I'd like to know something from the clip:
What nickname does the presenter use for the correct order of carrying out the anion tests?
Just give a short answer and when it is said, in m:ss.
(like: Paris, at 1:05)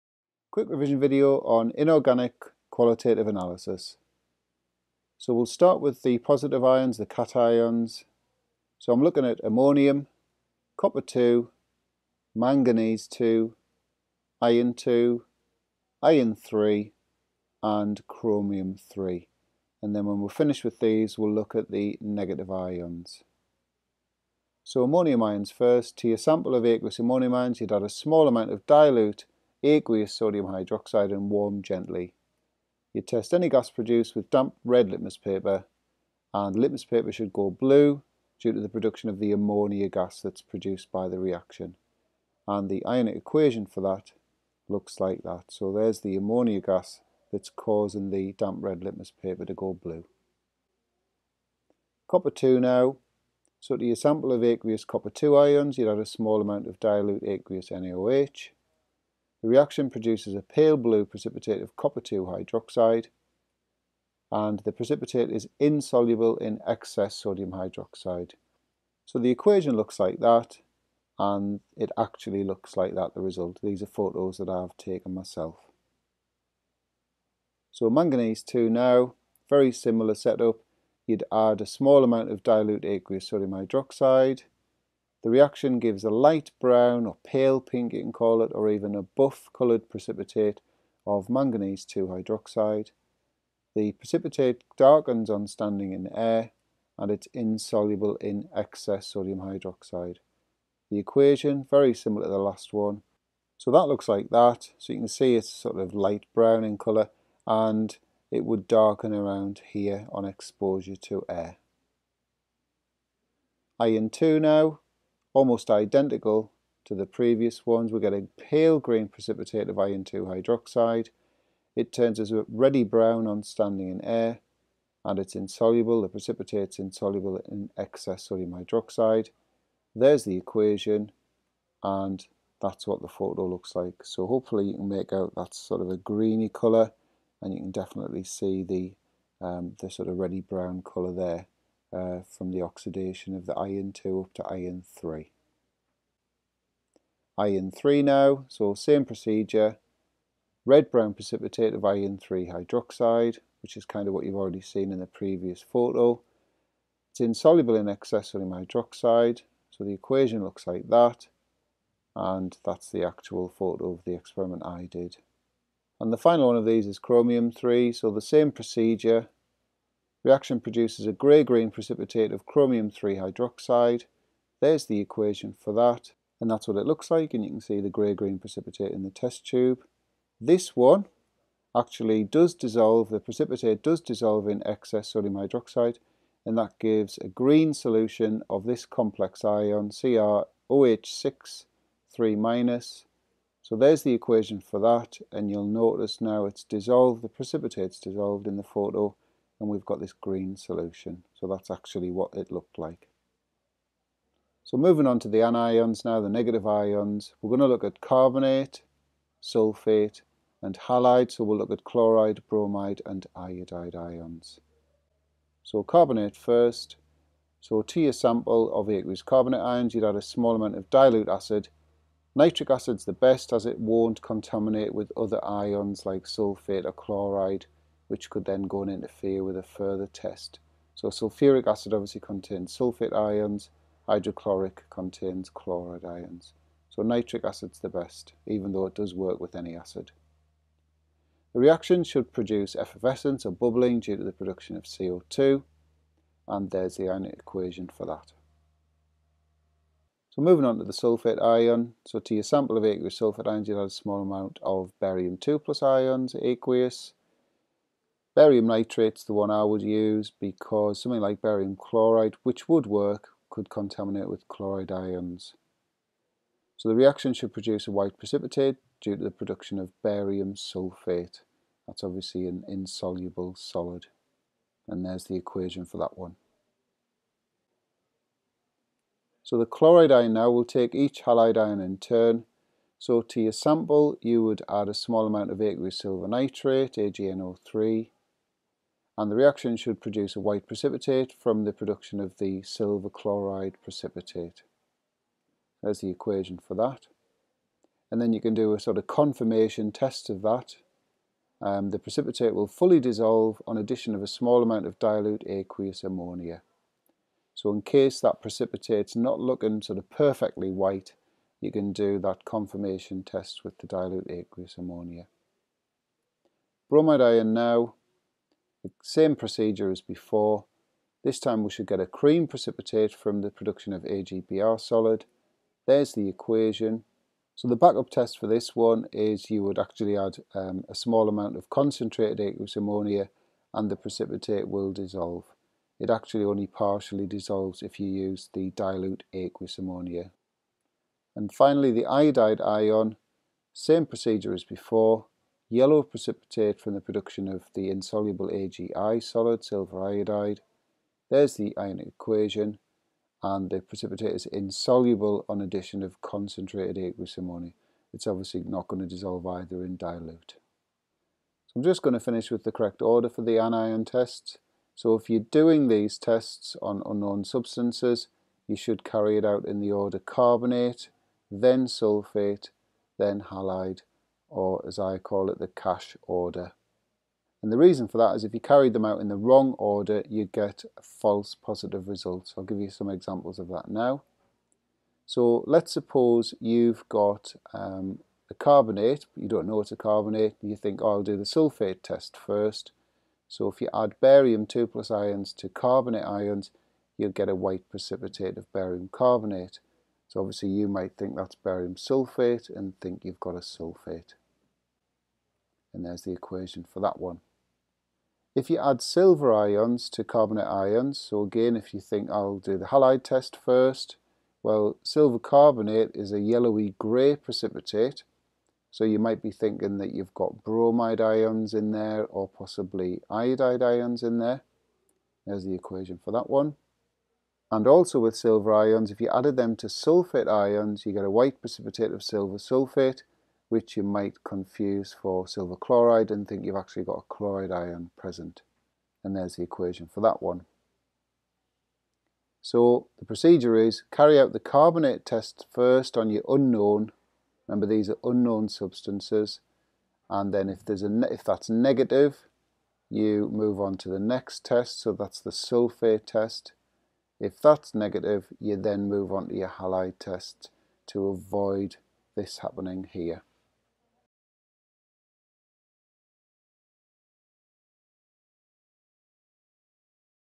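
the cash order, at 6:15.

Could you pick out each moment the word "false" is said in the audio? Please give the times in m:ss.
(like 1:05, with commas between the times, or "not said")
6:21.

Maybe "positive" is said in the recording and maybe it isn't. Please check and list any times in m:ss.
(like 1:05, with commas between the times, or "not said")
0:06, 6:21.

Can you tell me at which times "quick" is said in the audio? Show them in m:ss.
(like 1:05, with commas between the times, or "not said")
0:00.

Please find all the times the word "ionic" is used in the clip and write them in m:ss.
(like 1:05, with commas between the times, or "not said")
0:42, 4:07, 5:51.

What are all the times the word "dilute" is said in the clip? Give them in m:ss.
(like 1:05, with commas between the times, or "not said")
0:28, 0:56, 1:22, 3:40, 5:04, 5:13, 5:38, 5:59.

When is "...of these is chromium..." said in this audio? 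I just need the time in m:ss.
2:46.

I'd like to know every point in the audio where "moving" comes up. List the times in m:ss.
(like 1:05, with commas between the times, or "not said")
3:24, 4:10.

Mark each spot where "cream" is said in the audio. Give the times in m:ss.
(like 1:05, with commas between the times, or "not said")
5:22.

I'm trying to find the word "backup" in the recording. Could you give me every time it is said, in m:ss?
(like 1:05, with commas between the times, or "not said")
5:27.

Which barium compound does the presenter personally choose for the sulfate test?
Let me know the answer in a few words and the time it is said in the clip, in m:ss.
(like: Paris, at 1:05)
barium nitrate, at 4:18.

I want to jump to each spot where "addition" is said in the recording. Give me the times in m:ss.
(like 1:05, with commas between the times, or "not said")
5:03, 5:55.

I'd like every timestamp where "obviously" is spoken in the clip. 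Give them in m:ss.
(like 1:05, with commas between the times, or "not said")
3:51, 4:32, 5:58, 6:40.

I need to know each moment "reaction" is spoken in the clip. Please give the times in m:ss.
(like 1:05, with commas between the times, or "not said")
0:41, 0:59, 1:25, 2:50, 4:01, 4:26, 4:49.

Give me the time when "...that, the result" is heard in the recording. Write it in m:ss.
1:12.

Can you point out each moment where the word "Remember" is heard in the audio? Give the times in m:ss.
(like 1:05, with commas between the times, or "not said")
7:27.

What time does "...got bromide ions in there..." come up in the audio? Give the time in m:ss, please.
7:00.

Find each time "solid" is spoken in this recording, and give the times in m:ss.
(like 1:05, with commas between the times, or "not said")
4:33, 5:24, 5:49.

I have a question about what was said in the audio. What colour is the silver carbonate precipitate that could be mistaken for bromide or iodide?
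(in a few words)
yellowy grey.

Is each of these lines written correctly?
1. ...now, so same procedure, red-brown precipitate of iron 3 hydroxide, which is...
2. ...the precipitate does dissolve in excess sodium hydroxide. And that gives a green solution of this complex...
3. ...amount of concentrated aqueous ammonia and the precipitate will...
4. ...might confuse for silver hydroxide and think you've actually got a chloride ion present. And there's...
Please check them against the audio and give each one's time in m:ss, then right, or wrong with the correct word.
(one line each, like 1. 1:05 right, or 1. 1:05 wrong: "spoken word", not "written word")
1. 2:28 right
2. 3:03 right
3. 5:31 right
4. 7:14 wrong: "chloride", not "hydroxide".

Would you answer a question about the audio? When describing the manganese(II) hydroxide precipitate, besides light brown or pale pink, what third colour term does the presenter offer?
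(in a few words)
buff.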